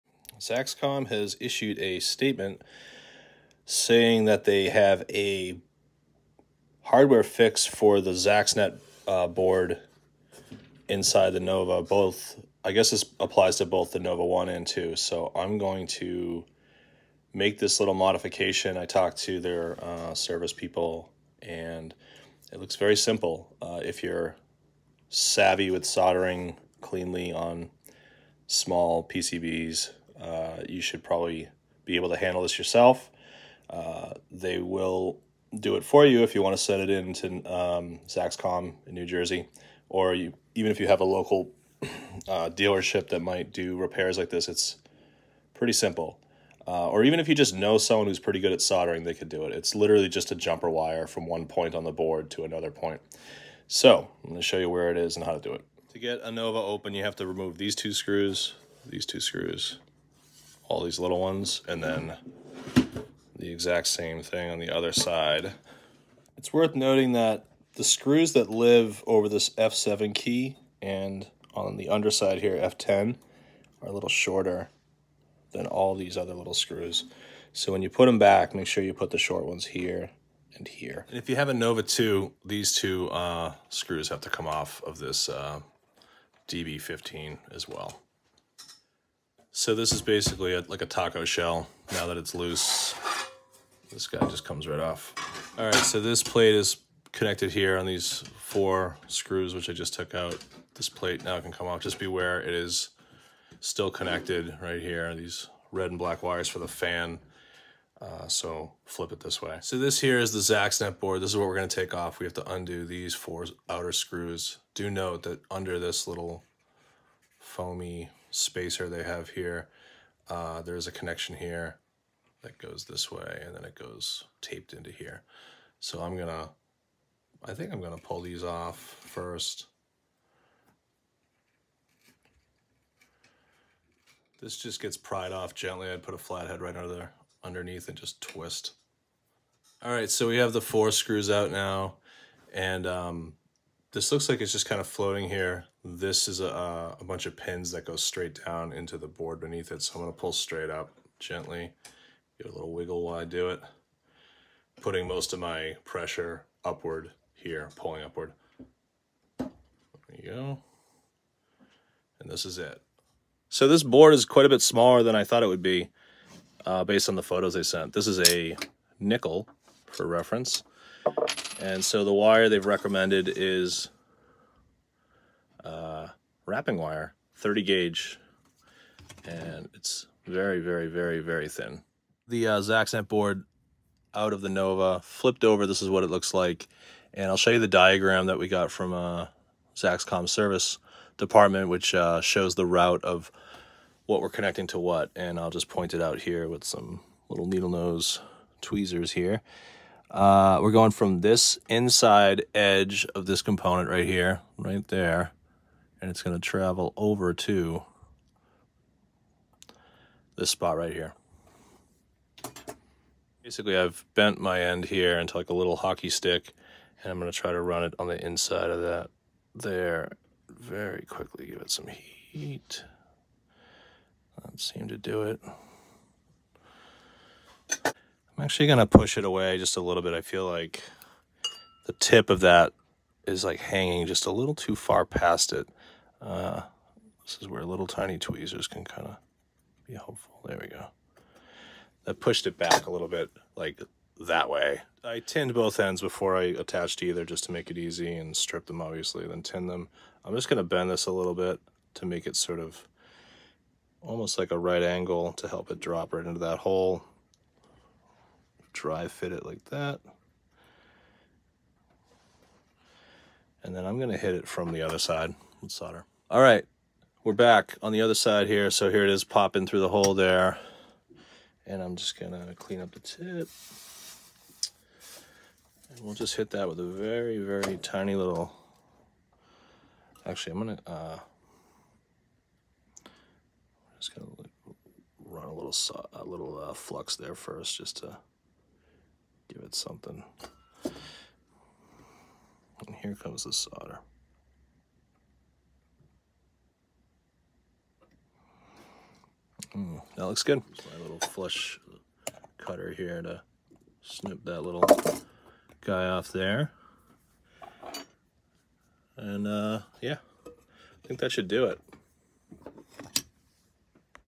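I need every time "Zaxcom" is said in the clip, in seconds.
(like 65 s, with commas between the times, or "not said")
0 s, 38 s, 189 s.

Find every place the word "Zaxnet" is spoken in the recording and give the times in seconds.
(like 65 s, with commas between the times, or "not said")
8 s, 110 s, 182 s.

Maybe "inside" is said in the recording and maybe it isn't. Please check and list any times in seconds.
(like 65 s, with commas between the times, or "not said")
10 s, 201 s, 218 s.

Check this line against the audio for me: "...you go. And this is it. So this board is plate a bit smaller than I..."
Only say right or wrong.
wrong.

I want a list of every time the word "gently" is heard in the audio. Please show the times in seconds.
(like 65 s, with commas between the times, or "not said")
135 s, 151 s.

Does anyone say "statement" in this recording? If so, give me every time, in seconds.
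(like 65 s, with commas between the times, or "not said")
1 s.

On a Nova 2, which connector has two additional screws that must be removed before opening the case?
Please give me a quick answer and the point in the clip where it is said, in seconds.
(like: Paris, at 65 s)
DB15, at 86 s.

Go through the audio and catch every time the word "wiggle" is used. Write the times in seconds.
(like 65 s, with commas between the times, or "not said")
152 s.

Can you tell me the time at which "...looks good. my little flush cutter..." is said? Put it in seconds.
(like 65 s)
300 s.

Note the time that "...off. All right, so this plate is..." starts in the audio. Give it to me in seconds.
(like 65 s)
94 s.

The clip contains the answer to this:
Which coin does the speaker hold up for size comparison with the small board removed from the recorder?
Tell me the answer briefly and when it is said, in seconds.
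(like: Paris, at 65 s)
A nickel, at 168 s.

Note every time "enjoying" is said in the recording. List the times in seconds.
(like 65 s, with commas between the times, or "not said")
not said.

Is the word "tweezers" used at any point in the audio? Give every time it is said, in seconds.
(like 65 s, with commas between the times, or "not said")
198 s, 238 s.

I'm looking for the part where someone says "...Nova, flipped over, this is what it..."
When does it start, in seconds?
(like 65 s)
184 s.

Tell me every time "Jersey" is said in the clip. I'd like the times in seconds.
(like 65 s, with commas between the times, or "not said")
39 s.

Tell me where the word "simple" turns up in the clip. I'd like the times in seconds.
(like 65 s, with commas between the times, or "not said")
22 s, 45 s.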